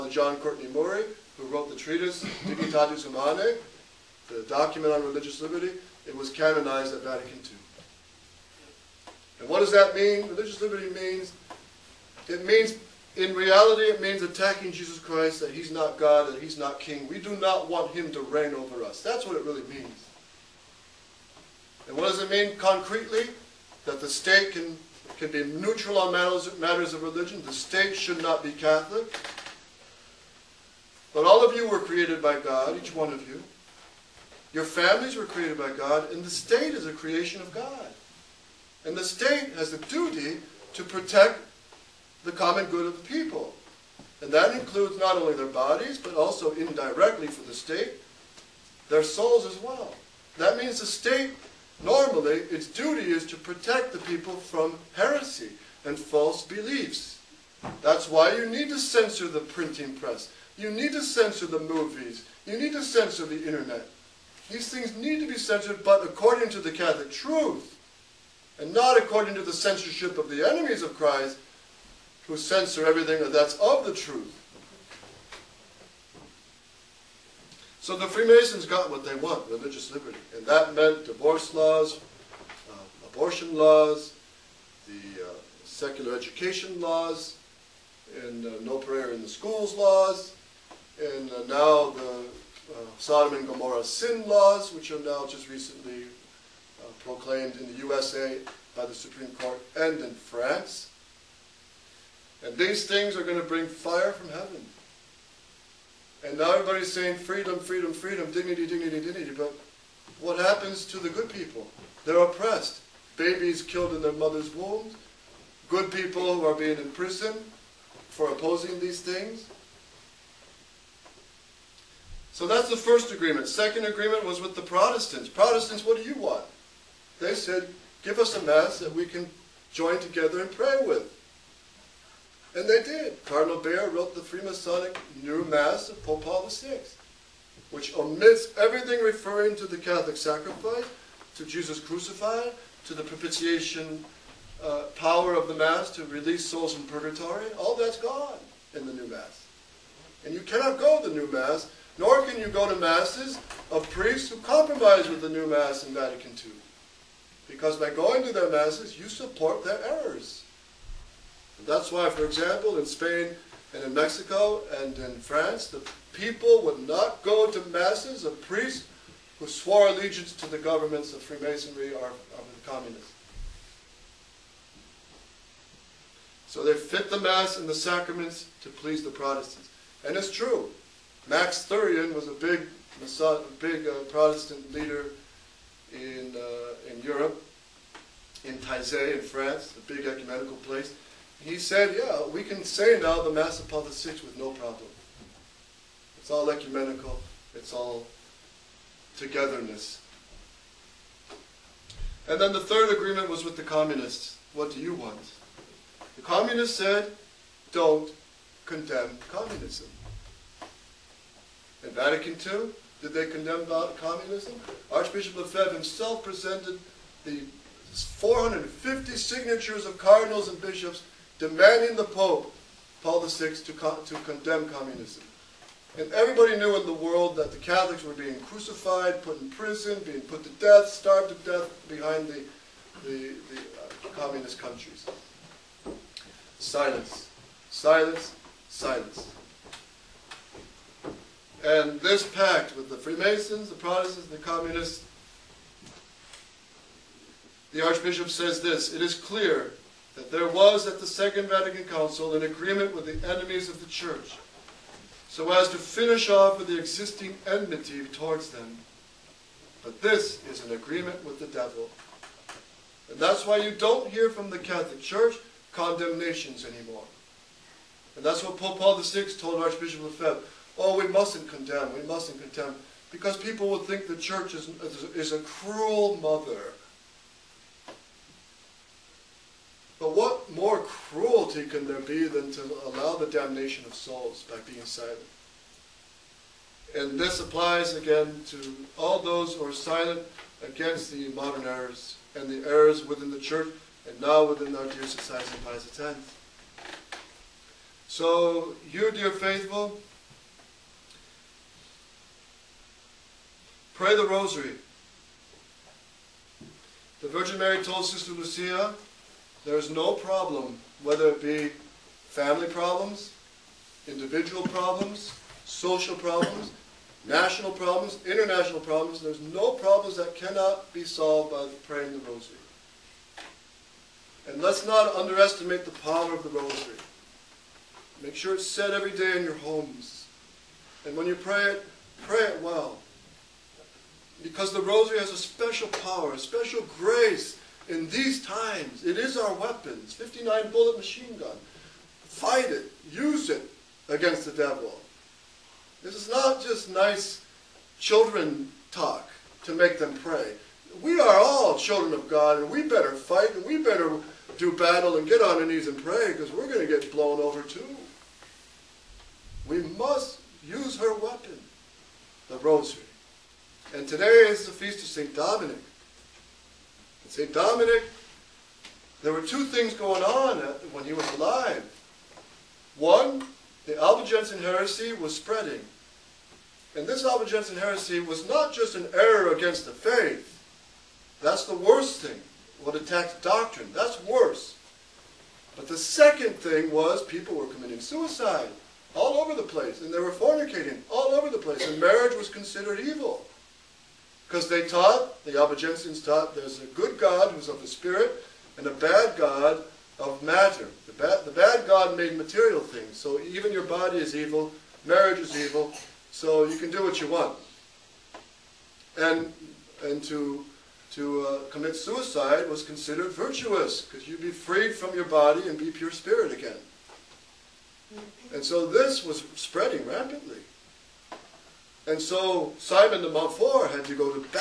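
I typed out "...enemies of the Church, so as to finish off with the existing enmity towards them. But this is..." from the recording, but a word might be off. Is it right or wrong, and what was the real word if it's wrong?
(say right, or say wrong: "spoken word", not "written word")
right.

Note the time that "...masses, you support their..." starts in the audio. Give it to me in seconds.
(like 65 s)
158 s.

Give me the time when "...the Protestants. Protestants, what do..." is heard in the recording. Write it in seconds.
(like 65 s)
124 s.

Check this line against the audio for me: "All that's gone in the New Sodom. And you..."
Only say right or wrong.
wrong.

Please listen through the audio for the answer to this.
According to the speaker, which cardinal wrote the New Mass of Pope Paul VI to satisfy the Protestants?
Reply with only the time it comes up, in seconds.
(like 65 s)
133 s.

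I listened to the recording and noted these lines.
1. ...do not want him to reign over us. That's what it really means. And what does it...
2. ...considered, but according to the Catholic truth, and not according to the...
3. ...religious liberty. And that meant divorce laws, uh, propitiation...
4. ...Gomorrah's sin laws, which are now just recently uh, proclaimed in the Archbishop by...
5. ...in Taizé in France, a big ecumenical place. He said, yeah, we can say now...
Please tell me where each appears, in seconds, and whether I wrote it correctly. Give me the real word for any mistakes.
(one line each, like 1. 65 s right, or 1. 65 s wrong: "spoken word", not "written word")
1. 17 s right
2. 65 s wrong: "censored", not "considered"
3. 79 s wrong: "abortion", not "propitiation"
4. 93 s wrong: "USA", not "Archbishop"
5. 188 s right.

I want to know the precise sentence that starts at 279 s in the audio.
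But what more cruelty can there be than to allow the damnation of souls by being silent?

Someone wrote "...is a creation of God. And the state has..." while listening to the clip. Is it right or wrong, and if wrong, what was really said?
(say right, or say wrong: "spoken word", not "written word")
right.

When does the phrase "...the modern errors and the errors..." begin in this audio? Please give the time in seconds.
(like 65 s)
291 s.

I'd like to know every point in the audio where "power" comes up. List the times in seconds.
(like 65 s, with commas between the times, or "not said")
144 s, 325 s, 335 s.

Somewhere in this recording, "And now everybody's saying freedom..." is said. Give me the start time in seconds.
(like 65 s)
106 s.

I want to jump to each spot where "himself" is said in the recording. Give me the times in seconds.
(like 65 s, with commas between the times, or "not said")
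215 s.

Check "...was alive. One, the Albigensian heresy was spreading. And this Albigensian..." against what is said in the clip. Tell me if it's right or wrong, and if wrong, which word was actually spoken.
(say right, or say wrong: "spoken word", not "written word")
right.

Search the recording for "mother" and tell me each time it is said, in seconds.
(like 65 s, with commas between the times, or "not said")
114 s, 276 s.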